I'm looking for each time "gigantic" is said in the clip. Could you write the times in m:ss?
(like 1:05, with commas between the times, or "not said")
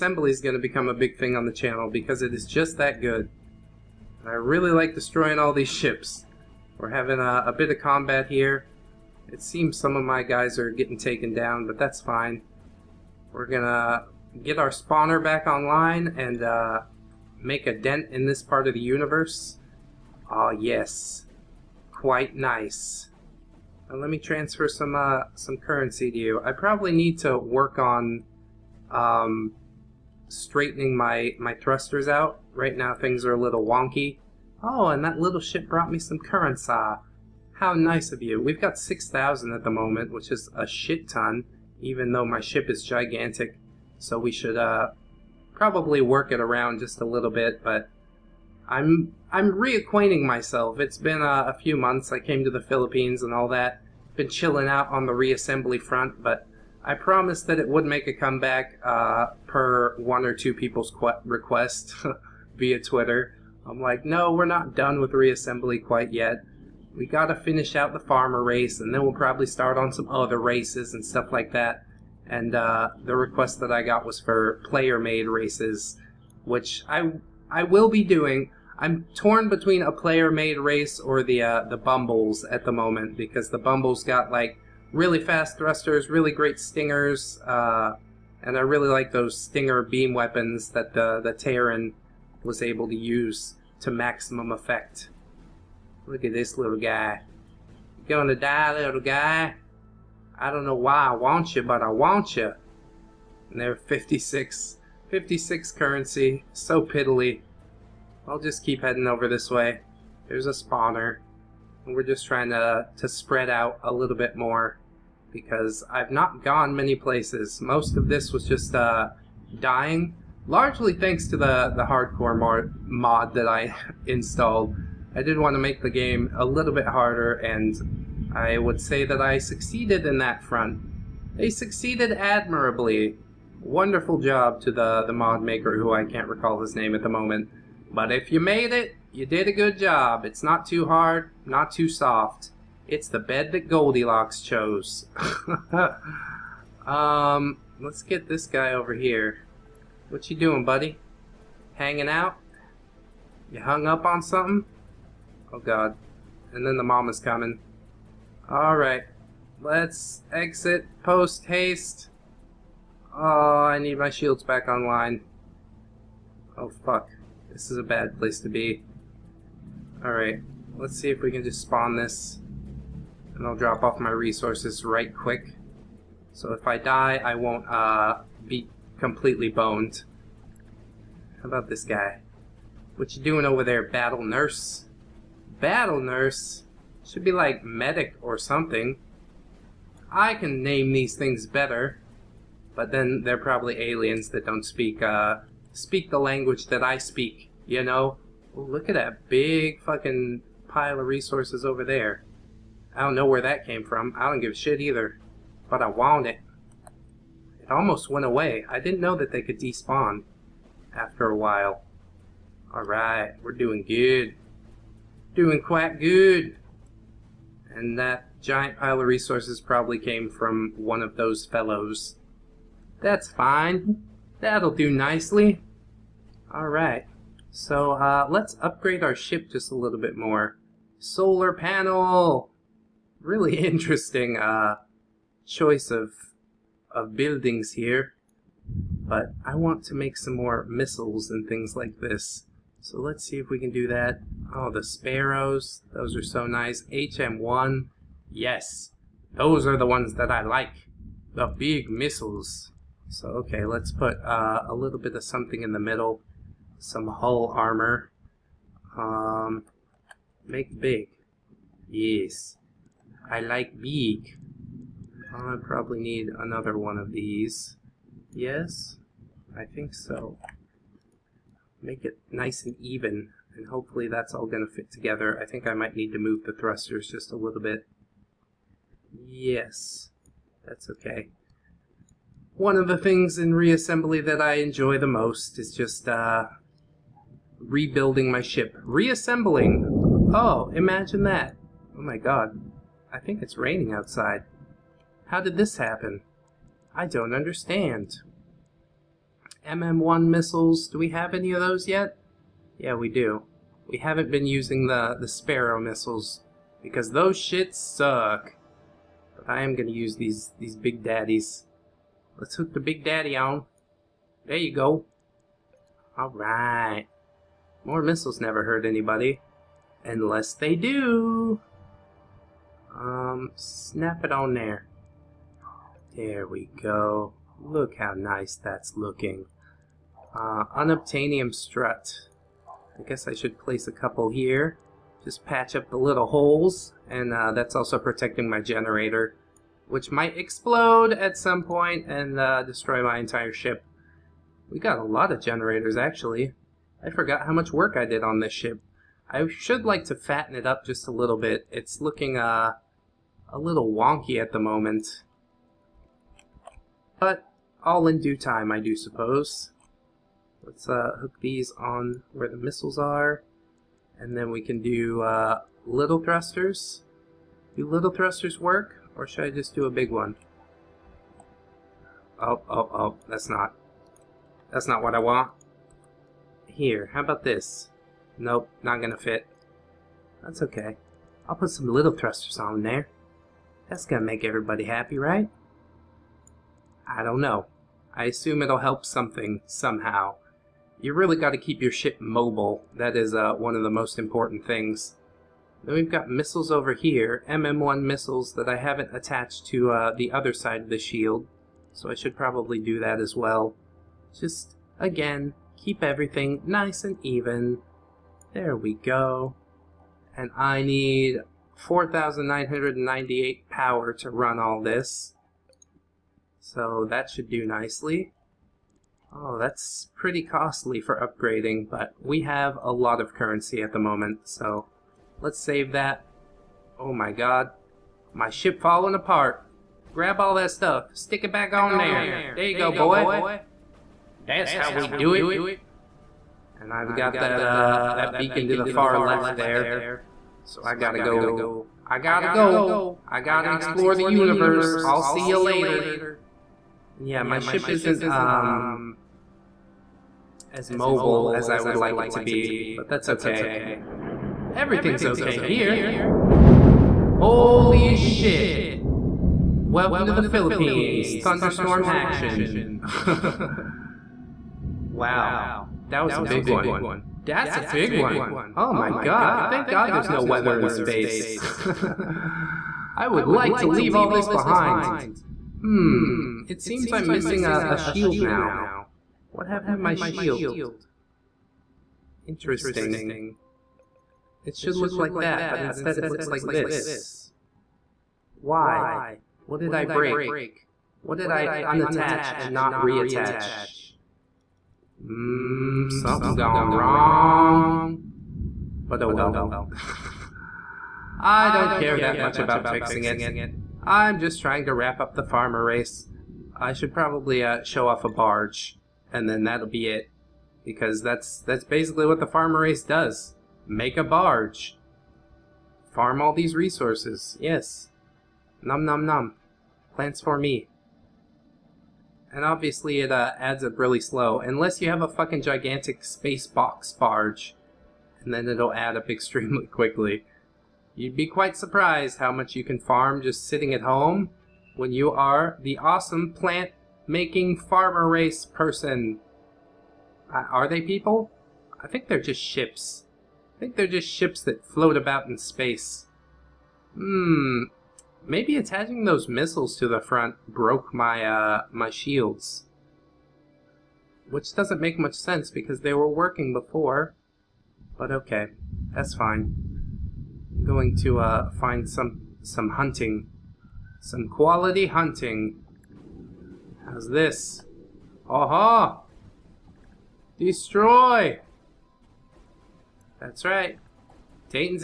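0:42, 8:45.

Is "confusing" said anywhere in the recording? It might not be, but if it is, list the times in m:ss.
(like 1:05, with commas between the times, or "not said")
not said.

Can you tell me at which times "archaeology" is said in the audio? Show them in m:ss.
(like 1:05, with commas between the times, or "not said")
not said.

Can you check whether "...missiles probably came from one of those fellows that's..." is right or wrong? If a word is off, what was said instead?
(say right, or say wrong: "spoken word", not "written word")
wrong: "resources", not "missiles".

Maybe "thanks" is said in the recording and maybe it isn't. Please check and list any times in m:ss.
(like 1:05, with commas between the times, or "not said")
2:00, 7:49.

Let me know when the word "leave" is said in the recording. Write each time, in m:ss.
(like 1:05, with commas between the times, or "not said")
7:53.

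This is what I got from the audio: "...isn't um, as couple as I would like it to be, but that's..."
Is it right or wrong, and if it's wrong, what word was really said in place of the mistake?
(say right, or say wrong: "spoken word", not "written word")
wrong: "mobile", not "couple".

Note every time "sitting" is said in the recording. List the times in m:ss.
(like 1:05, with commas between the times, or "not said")
8:53.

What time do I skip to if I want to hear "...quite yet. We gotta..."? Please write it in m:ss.
1:05.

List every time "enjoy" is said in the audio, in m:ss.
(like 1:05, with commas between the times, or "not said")
4:44.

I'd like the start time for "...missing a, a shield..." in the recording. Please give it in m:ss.
7:57.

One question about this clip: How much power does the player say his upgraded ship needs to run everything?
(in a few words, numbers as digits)
4,998.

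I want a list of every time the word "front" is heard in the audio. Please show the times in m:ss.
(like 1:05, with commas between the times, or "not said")
0:55, 2:10, 9:10.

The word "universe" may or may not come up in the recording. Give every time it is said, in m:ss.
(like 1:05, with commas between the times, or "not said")
0:18, 7:24.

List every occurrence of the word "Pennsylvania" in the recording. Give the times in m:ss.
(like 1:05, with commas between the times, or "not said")
not said.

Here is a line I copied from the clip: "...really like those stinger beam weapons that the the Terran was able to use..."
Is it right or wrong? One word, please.
right.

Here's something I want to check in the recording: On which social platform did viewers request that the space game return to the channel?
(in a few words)
Twitter.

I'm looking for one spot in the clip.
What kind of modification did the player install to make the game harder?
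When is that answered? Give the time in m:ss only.
2:01.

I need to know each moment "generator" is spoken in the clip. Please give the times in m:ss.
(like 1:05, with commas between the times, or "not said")
5:38, 5:45.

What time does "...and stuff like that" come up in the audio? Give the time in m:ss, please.
1:10.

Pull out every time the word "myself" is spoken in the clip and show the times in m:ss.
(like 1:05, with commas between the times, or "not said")
0:50.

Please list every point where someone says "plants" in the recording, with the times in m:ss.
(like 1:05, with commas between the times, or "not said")
8:40, 8:56.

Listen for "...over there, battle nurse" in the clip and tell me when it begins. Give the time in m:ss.
3:03.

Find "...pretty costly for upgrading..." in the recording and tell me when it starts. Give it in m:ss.
7:00.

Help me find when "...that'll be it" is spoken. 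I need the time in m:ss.
8:29.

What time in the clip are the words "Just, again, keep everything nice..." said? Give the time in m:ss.
6:44.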